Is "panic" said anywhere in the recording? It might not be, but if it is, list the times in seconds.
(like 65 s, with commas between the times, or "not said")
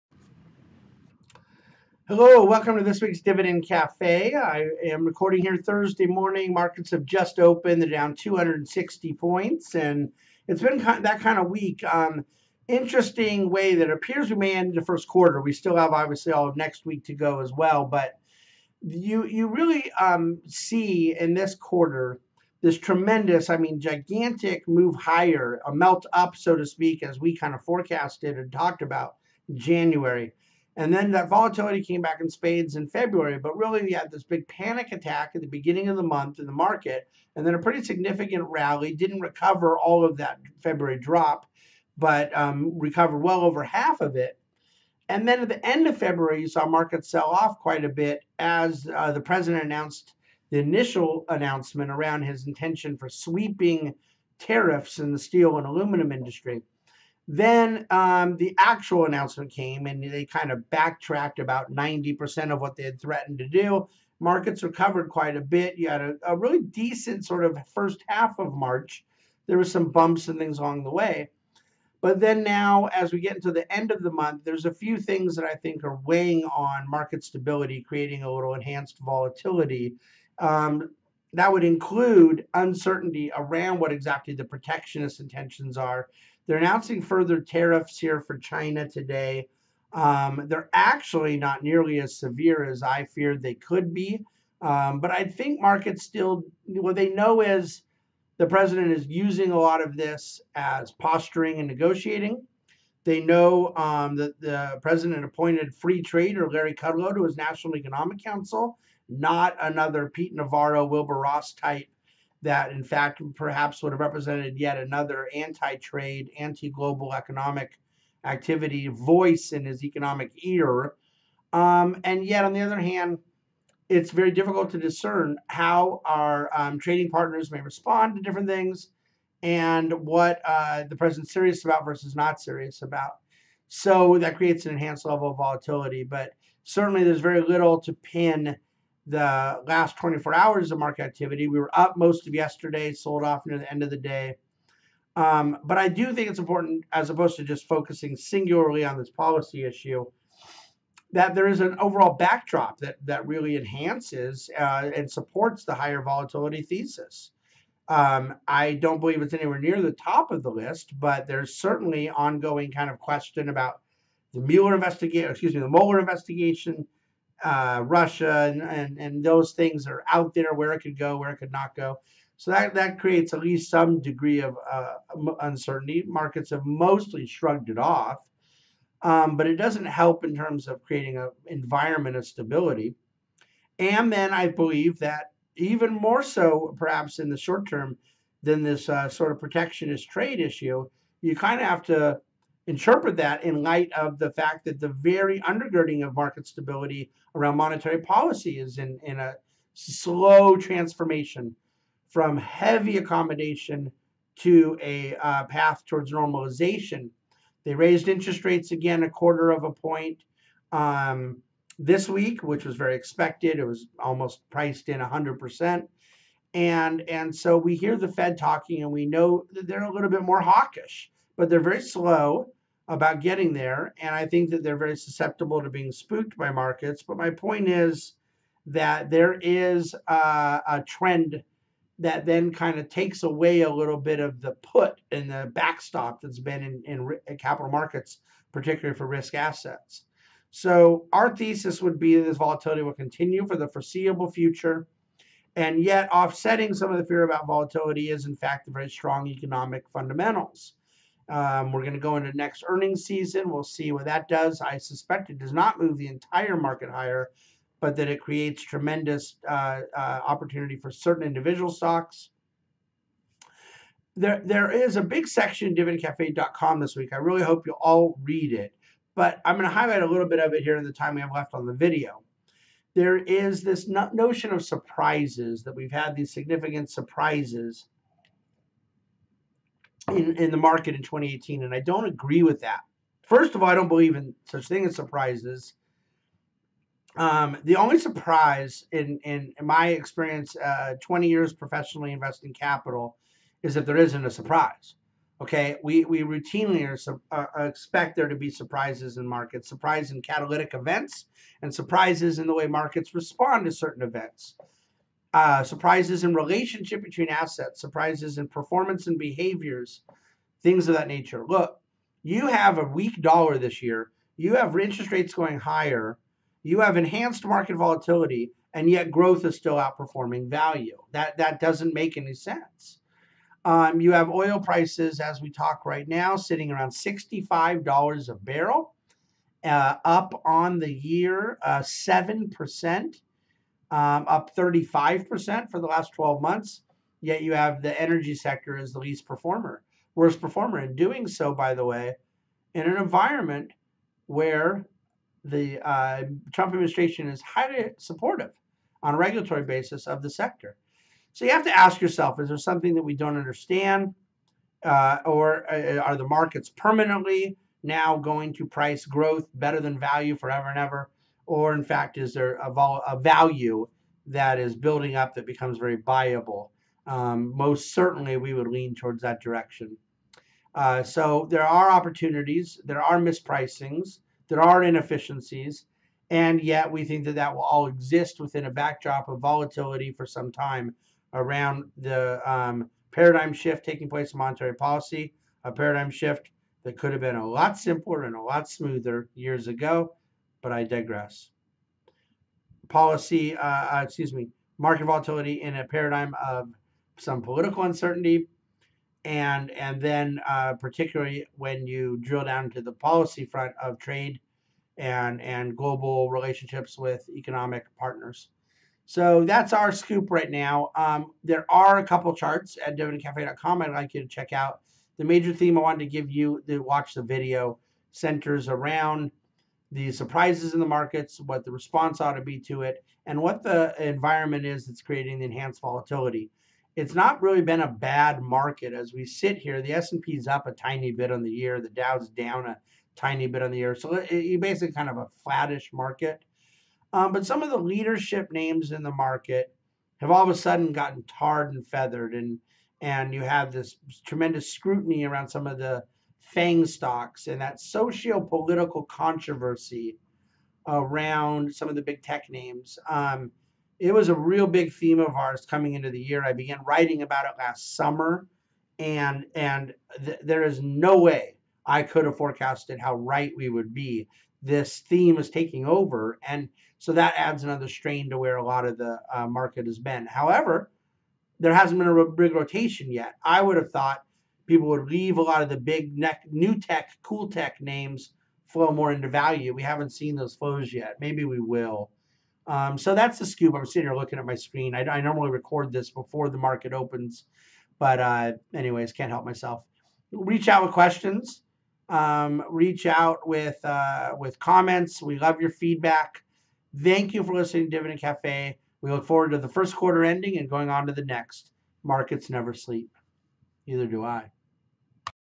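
34 s.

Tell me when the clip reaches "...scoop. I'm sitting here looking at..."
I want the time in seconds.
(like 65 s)
483 s.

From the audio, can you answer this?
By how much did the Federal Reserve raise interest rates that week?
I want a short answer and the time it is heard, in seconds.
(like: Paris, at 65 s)
a quarter of a point, at 209 s.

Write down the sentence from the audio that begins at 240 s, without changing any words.
So our thesis would be that this volatility will continue for the foreseeable future.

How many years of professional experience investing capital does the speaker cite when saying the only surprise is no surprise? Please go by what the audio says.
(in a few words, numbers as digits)
20 years.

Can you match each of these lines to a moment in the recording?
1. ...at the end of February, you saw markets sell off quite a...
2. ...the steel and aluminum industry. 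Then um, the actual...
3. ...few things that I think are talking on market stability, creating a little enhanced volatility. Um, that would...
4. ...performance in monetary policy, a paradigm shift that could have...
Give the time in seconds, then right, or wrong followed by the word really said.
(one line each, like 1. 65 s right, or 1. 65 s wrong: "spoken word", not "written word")
1. 45 s right
2. 55 s right
3. 74 s wrong: "weighing", not "talking"
4. 384 s wrong: "place", not "performance".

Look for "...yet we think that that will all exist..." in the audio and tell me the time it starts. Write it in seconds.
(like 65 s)
376 s.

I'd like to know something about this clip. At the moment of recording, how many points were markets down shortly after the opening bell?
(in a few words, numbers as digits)
260.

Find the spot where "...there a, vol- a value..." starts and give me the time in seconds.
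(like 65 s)
362 s.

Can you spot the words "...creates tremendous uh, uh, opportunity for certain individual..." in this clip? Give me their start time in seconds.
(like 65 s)
258 s.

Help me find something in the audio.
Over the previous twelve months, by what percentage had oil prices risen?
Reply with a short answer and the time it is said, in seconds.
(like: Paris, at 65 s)
35%, at 334 s.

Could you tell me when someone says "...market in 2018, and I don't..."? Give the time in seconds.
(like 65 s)
280 s.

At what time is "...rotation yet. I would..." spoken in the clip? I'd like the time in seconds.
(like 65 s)
472 s.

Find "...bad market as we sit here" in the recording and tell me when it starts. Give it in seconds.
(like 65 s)
427 s.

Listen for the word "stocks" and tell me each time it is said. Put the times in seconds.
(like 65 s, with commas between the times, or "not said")
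261 s, 446 s.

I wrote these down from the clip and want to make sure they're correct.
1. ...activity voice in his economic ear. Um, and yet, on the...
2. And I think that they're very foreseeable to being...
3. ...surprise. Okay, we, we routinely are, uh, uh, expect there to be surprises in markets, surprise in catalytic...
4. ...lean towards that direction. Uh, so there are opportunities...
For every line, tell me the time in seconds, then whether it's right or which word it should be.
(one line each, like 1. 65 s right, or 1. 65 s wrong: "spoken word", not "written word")
1. 118 s right
2. 224 s wrong: "susceptible", not "foreseeable"
3. 294 s right
4. 368 s right.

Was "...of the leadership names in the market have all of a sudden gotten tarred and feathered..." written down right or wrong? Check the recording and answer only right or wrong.
right.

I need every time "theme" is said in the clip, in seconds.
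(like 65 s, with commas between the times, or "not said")
415 s, 454 s, 465 s.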